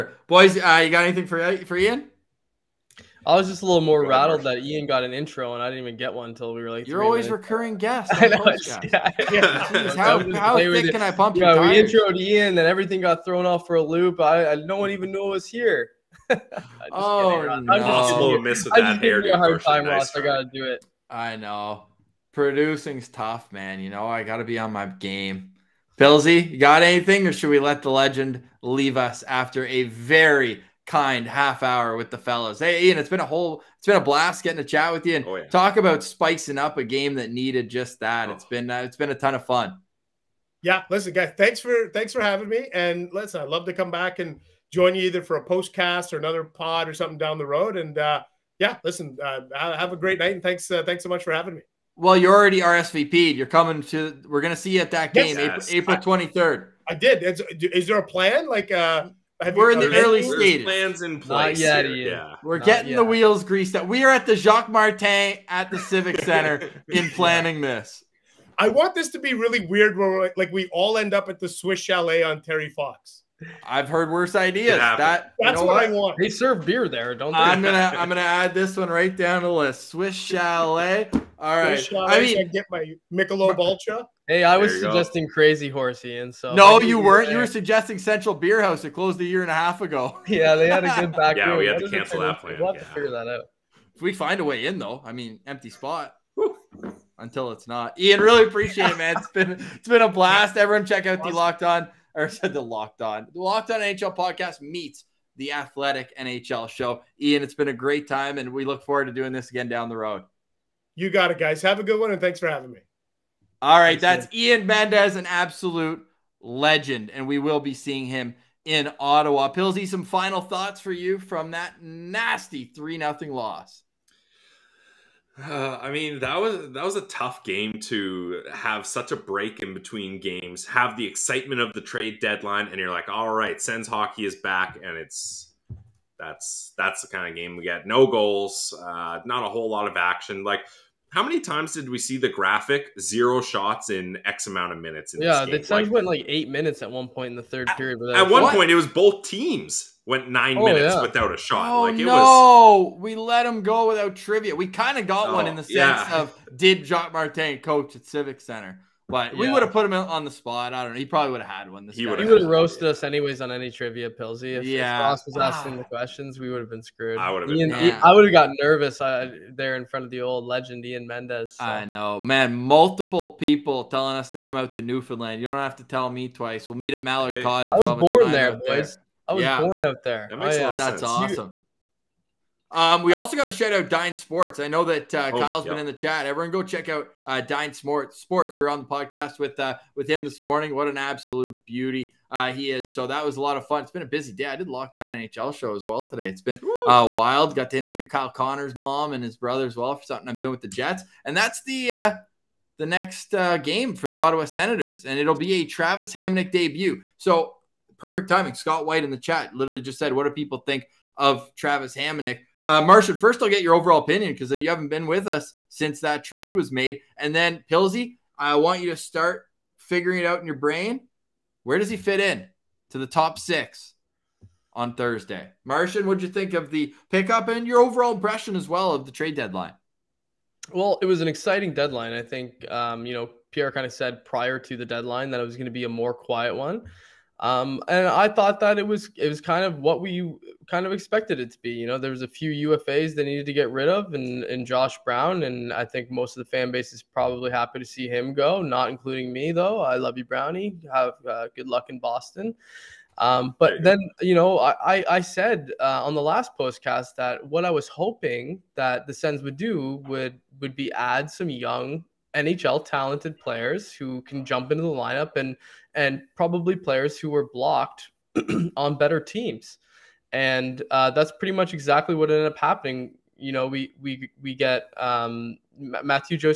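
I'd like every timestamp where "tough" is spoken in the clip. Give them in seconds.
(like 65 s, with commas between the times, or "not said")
23 s, 127 s.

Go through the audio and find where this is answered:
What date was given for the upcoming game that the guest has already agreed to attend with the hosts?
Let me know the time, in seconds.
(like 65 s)
55 s.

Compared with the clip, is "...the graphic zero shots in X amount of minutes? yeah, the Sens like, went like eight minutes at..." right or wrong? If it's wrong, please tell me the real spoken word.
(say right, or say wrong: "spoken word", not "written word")
right.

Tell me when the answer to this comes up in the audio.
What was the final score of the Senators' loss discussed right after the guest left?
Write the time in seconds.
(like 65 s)
122 s.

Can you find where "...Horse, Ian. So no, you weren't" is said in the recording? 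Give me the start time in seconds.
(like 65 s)
85 s.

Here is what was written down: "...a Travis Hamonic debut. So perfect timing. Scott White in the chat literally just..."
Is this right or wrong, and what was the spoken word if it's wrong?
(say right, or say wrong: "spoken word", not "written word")
right.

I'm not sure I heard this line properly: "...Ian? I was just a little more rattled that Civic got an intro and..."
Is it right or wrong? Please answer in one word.
wrong.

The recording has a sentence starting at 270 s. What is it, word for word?
And uh, that's pretty much exactly what ended up happening.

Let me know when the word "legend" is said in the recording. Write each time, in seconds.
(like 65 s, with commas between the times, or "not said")
27 s, 116 s, 170 s.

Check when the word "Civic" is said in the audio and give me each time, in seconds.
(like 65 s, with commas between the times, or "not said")
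65 s, 158 s.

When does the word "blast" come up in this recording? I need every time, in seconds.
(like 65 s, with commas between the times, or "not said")
34 s, 100 s.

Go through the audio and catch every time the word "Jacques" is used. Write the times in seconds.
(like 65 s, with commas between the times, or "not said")
64 s, 156 s.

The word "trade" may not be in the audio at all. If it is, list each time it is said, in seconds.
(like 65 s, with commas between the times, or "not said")
131 s, 216 s, 229 s.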